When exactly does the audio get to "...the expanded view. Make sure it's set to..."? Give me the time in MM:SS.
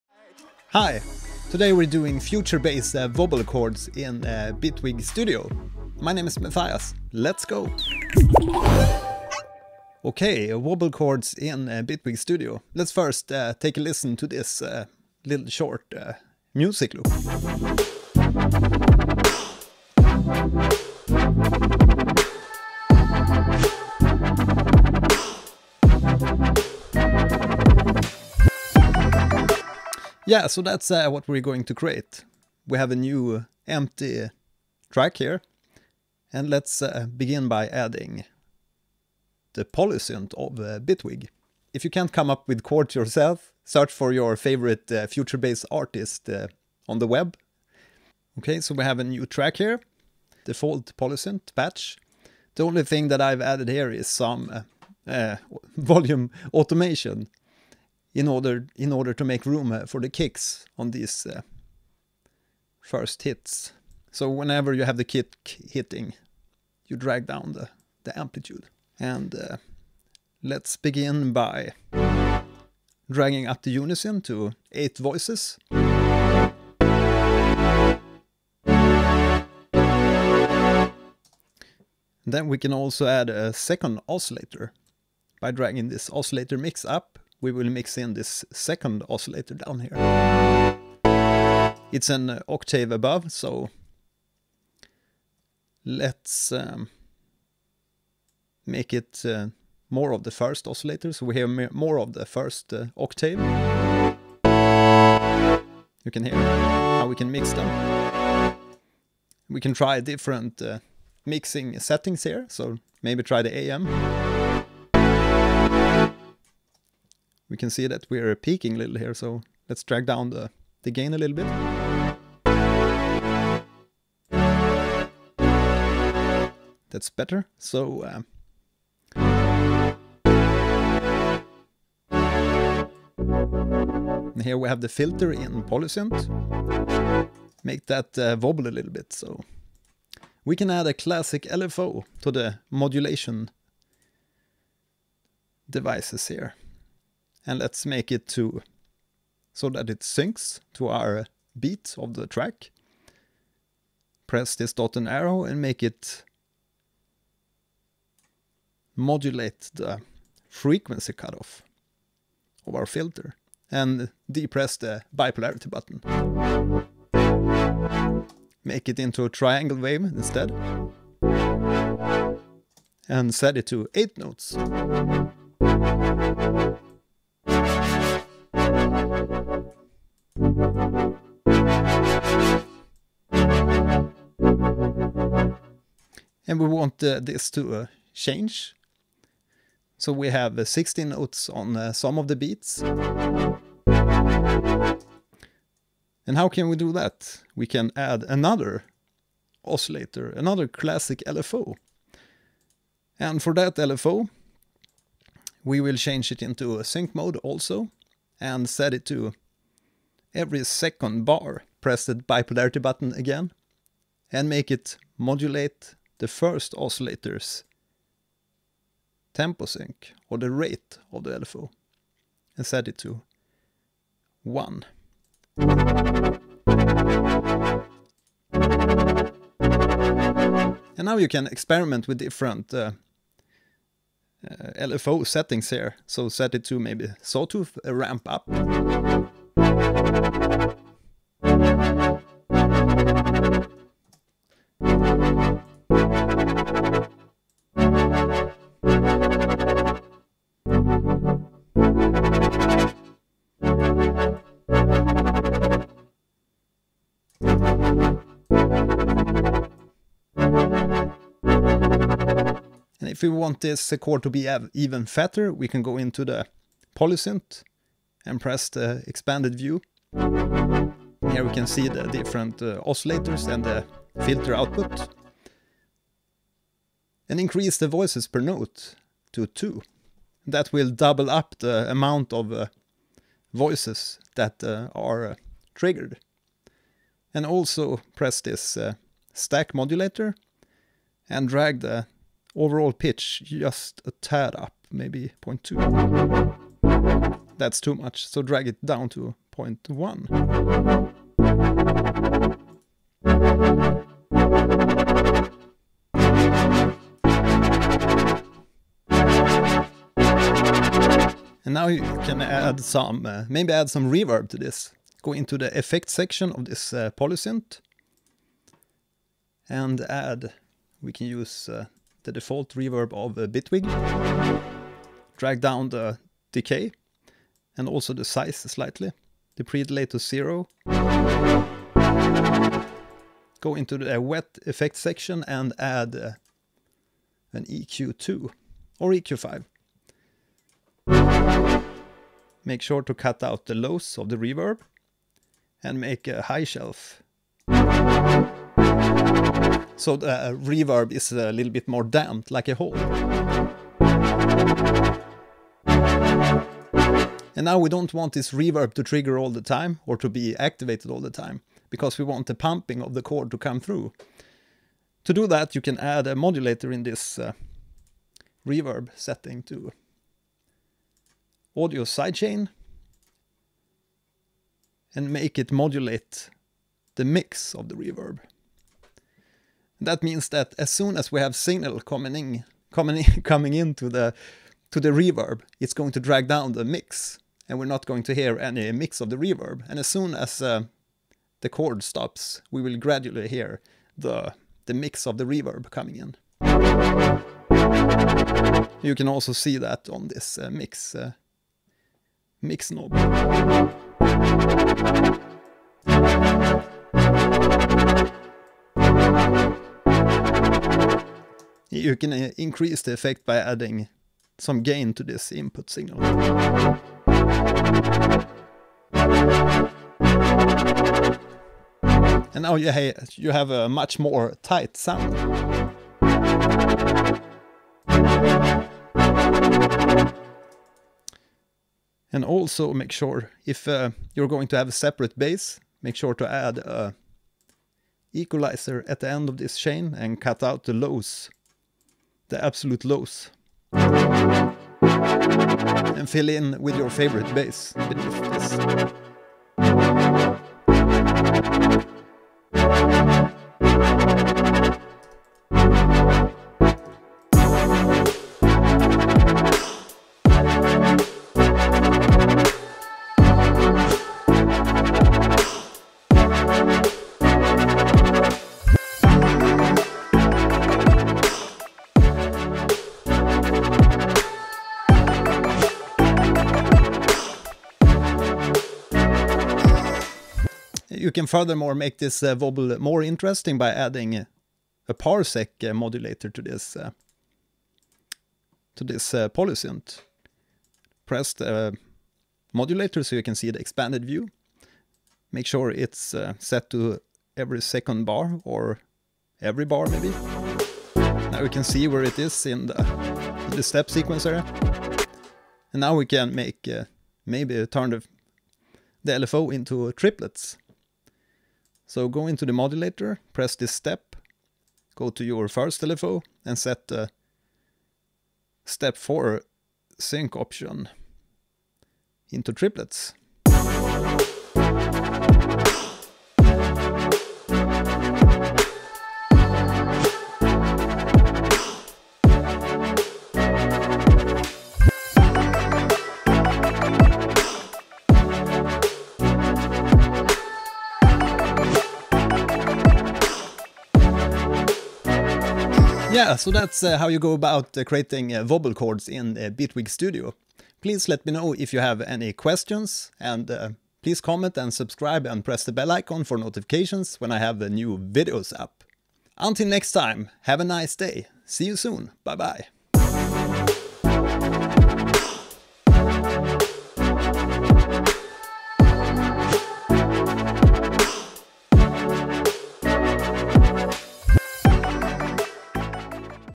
08:13.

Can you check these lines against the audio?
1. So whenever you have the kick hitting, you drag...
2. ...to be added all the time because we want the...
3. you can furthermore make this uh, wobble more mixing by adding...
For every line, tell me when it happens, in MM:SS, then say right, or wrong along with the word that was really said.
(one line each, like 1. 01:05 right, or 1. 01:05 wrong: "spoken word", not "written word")
1. 01:04 right
2. 06:00 wrong: "activated", not "added"
3. 08:01 wrong: "interesting", not "mixing".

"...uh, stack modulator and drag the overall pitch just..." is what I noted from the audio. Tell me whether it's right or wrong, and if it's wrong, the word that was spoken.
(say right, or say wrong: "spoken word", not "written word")
right.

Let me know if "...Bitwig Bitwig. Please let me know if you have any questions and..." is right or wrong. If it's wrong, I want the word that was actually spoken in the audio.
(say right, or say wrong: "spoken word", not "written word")
wrong: "Studio", not "Bitwig".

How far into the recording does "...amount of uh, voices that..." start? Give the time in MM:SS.
04:41.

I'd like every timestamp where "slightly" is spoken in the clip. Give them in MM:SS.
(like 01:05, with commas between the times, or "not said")
05:28.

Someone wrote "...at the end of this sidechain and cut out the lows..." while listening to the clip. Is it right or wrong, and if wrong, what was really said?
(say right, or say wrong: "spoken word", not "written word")
wrong: "chain", not "sidechain".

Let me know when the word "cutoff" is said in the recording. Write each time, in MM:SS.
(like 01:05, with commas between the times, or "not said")
02:41.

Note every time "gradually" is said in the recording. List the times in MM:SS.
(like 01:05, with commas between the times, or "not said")
06:32.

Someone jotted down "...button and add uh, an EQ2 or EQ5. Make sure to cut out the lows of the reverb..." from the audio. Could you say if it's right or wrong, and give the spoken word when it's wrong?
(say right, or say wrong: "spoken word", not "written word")
wrong: "section", not "button".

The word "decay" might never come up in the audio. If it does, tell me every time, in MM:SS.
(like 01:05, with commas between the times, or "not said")
05:26.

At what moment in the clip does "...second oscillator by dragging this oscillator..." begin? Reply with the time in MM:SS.
01:23.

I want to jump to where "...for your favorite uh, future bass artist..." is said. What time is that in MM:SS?
00:43.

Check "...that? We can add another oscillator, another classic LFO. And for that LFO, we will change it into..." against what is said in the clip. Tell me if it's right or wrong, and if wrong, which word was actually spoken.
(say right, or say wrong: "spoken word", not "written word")
right.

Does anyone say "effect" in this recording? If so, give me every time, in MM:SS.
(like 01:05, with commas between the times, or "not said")
05:15, 05:34, 06:53.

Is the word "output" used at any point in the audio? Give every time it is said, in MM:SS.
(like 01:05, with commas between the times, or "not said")
04:34.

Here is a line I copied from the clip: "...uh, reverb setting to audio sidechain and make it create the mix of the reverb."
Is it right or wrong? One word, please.
wrong.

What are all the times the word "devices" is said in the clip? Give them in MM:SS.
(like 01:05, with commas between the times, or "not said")
02:25.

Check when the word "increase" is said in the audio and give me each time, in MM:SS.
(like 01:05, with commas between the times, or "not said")
04:37, 06:52.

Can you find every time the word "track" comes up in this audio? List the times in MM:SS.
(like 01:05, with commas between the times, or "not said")
00:34, 00:49, 02:32.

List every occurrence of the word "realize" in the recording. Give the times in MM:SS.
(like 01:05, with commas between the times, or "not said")
not said.